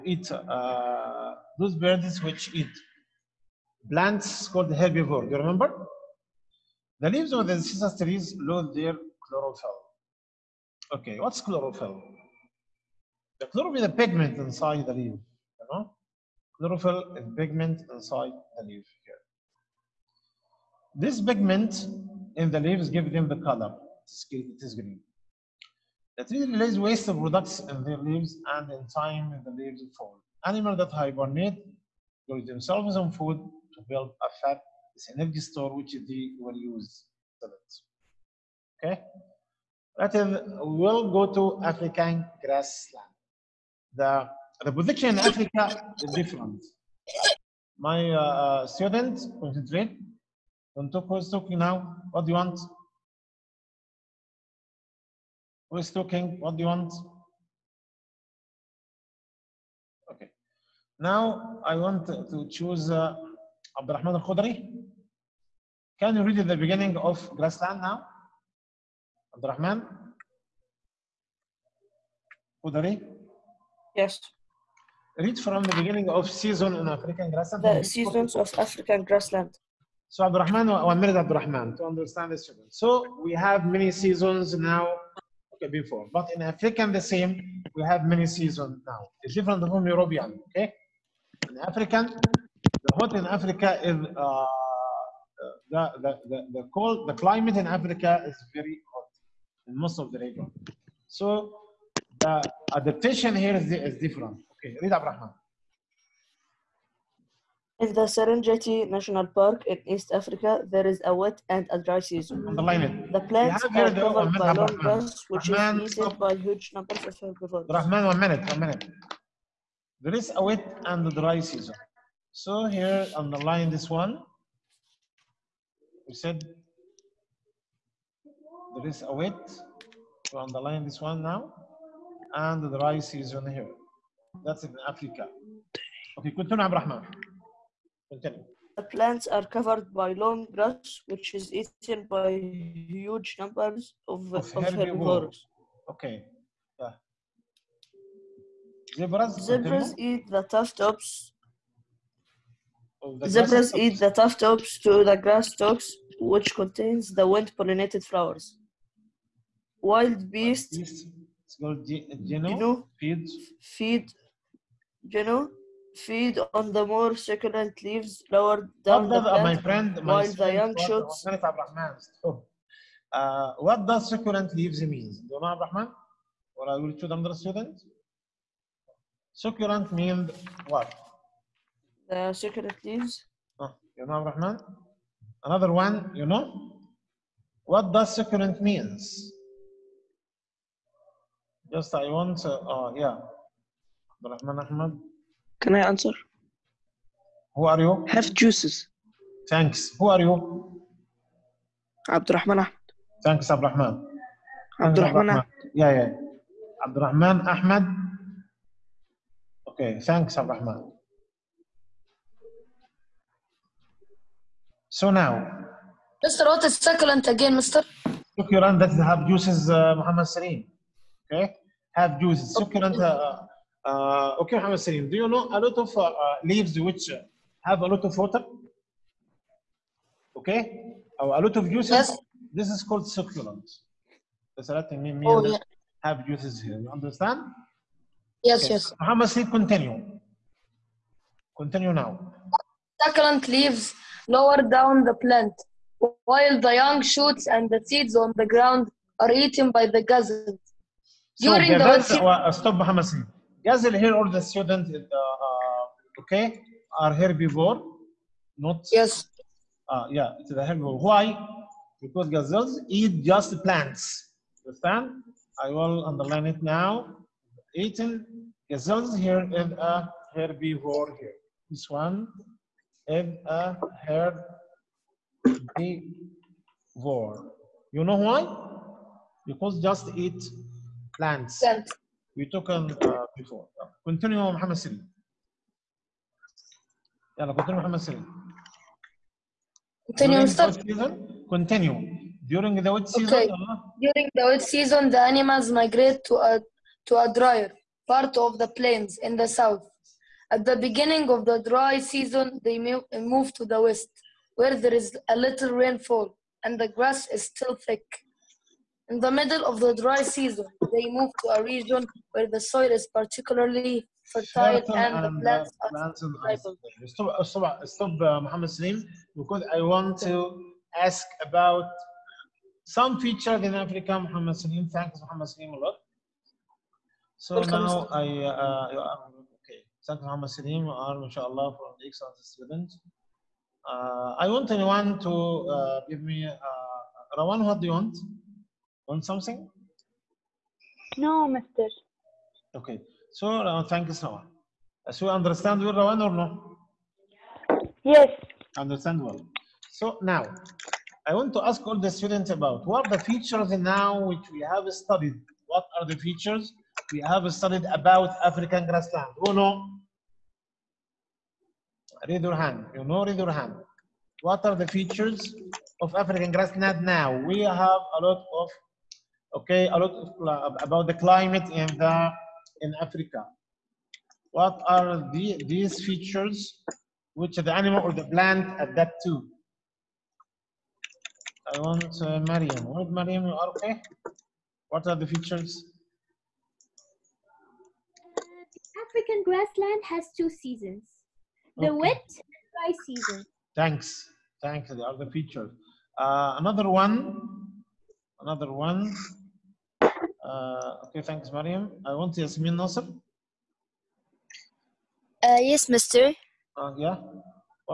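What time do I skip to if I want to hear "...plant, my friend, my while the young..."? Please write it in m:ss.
2:49.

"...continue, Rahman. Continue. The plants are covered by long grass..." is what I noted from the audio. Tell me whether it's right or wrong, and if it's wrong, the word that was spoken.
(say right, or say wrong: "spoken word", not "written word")
right.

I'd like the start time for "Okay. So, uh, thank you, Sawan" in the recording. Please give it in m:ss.
5:42.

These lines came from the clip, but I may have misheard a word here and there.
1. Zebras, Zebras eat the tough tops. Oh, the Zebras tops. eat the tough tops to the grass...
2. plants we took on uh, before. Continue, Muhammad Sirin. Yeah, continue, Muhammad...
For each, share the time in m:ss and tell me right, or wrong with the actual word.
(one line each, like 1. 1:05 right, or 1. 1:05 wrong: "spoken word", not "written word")
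1. 2:28 right
2. 4:41 right.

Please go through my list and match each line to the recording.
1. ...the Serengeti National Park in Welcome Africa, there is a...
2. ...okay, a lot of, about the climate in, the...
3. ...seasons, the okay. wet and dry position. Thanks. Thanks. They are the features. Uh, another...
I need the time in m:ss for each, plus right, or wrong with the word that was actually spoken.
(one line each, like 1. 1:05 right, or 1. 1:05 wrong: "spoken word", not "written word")
1. 1:47 wrong: "East", not "Welcome"
2. 6:09 right
3. 6:30 wrong: "season", not "position".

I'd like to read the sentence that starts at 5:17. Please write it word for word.
Stop, stop, stop uh, uh, uh Muhammad Salim, because I want to ask about some features in Africa, Muhammad Salim.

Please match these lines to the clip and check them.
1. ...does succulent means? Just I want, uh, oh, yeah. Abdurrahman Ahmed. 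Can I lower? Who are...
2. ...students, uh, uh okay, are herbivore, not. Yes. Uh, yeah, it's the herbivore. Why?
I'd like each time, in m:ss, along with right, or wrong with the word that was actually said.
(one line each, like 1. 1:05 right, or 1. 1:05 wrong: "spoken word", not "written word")
1. 3:07 wrong: "answer", not "lower"
2. 4:14 right.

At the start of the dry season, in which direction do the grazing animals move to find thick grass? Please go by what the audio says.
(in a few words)
West.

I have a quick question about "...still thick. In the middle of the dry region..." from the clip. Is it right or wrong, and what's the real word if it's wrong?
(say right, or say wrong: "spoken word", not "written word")
wrong: "season", not "region".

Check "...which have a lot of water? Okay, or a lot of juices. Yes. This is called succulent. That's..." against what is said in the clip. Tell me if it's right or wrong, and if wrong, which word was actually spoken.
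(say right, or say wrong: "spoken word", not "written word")
right.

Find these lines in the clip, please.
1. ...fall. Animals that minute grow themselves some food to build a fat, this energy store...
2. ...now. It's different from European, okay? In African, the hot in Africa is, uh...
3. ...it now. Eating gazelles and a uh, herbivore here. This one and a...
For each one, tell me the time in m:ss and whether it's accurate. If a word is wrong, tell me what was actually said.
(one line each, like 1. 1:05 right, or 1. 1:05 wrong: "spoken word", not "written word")
1. 0:29 wrong: "hibernate", not "minute"
2. 1:28 right
3. 4:26 right.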